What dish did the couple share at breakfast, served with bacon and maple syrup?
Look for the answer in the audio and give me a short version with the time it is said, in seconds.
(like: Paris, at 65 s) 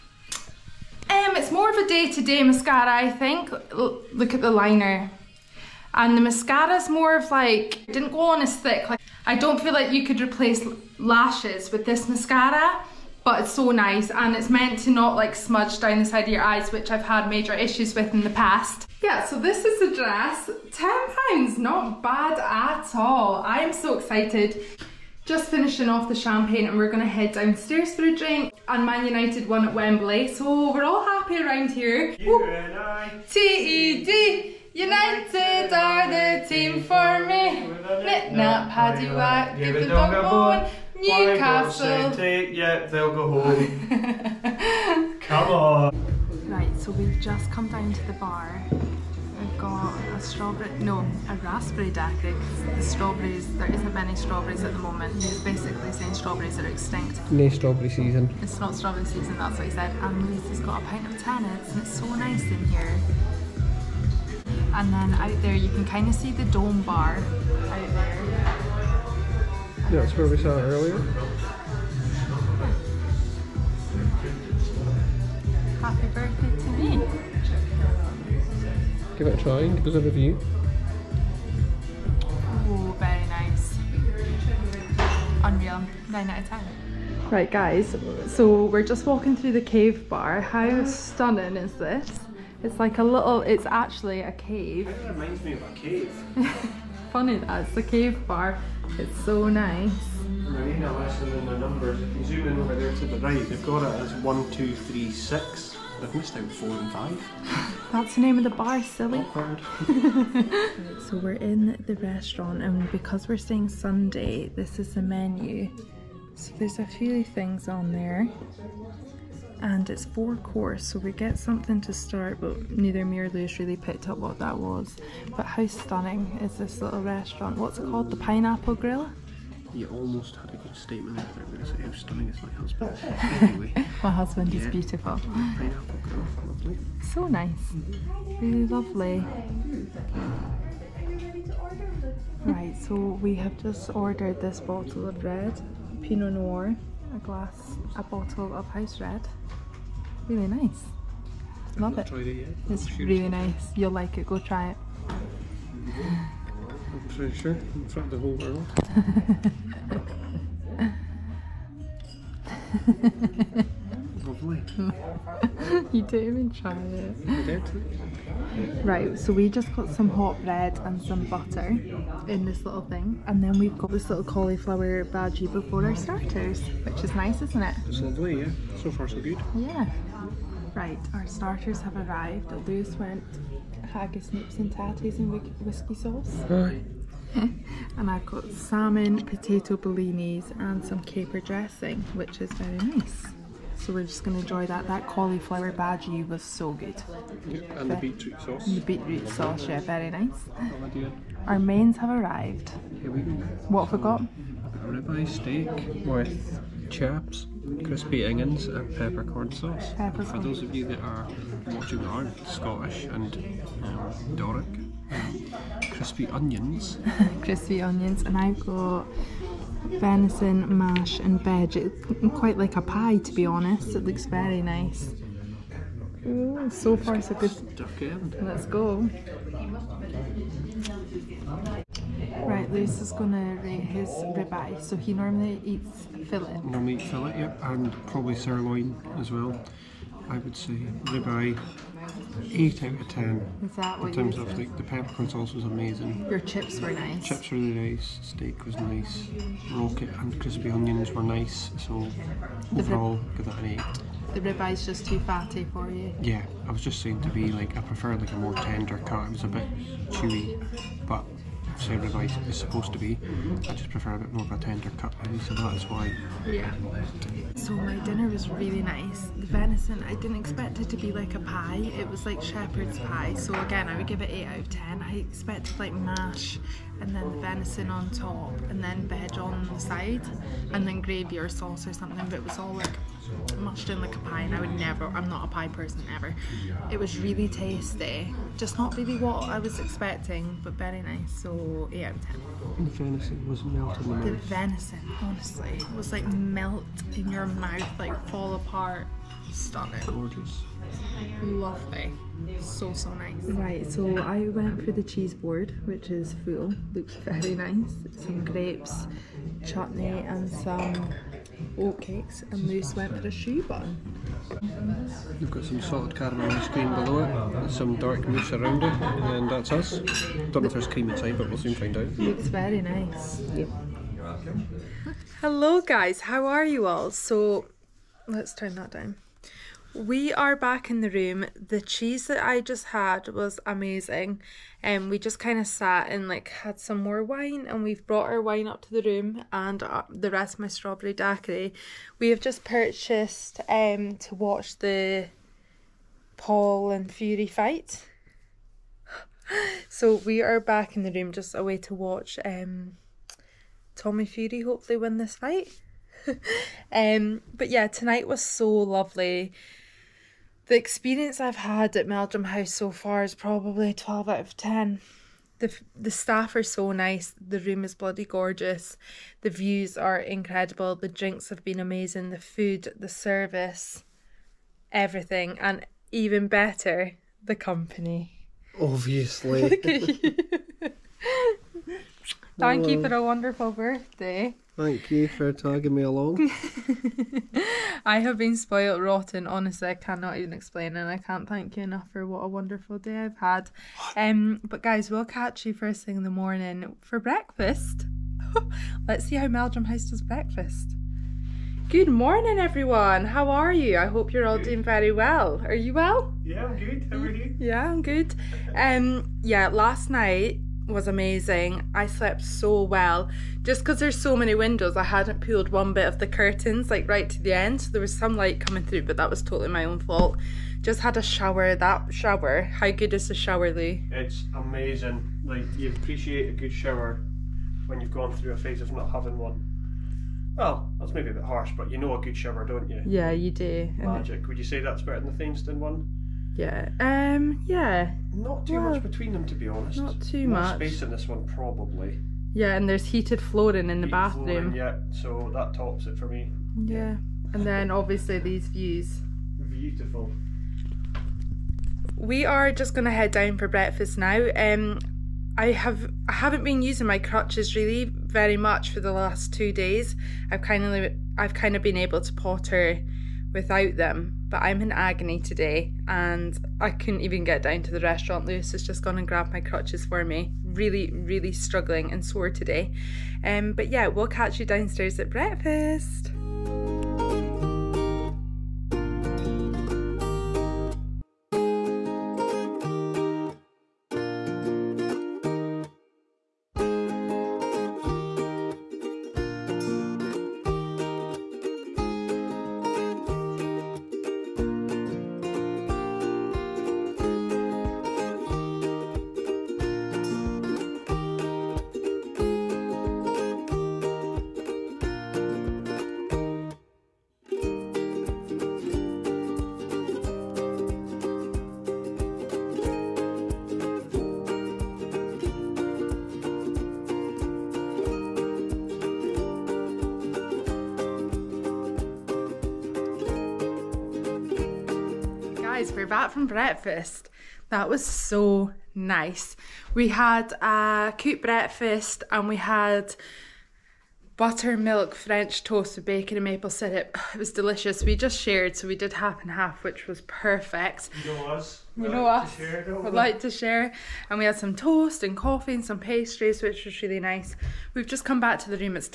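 buttermilk French toast, at 534 s.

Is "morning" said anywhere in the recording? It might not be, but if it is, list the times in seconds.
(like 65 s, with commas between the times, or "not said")
396 s, 402 s.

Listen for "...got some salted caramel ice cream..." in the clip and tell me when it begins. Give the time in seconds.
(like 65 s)
315 s.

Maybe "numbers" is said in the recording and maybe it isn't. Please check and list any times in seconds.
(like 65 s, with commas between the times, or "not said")
101 s.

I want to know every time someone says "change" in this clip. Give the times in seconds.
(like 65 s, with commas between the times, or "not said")
not said.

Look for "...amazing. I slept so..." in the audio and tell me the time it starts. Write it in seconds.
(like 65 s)
411 s.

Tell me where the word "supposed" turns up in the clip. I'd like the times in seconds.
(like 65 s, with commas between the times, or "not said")
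262 s.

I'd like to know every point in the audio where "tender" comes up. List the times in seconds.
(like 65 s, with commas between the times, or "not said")
258 s, 264 s.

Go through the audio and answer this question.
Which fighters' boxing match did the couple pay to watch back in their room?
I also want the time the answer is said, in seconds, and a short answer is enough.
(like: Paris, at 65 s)
Paul and Fury, at 346 s.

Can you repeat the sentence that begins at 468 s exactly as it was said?
Lewis has just gone and grabbed my crutches for me.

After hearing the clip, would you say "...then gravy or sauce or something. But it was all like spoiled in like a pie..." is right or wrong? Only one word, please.
wrong.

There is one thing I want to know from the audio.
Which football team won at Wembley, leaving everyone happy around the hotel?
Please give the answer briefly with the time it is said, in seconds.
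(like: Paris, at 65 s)
Man United, at 28 s.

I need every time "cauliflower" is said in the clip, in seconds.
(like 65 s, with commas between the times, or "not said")
174 s, 195 s.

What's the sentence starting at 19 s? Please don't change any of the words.
Yeah, so this is the dress.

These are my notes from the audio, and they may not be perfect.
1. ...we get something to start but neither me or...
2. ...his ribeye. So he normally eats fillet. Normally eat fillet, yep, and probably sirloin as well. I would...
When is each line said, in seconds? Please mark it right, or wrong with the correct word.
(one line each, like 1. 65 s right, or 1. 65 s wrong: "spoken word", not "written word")
1. 121 s right
2. 233 s right.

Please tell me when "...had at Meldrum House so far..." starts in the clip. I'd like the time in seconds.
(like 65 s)
361 s.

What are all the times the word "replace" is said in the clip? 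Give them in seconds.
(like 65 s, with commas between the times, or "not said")
10 s.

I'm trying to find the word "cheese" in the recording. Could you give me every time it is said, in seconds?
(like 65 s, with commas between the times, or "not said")
305 s, 331 s.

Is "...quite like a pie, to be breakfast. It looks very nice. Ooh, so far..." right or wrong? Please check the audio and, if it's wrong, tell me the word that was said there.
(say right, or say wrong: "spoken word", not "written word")
wrong: "honest", not "breakfast".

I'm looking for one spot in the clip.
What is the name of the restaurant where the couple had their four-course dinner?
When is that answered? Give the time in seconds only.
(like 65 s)
128 s.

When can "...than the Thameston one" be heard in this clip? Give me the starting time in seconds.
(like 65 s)
435 s.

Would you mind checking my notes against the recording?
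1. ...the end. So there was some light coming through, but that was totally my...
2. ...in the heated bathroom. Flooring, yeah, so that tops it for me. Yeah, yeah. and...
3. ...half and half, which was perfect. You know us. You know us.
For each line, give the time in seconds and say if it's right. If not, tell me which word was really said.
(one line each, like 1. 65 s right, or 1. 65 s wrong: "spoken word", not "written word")
1. 417 s right
2. 443 s right
3. 539 s right.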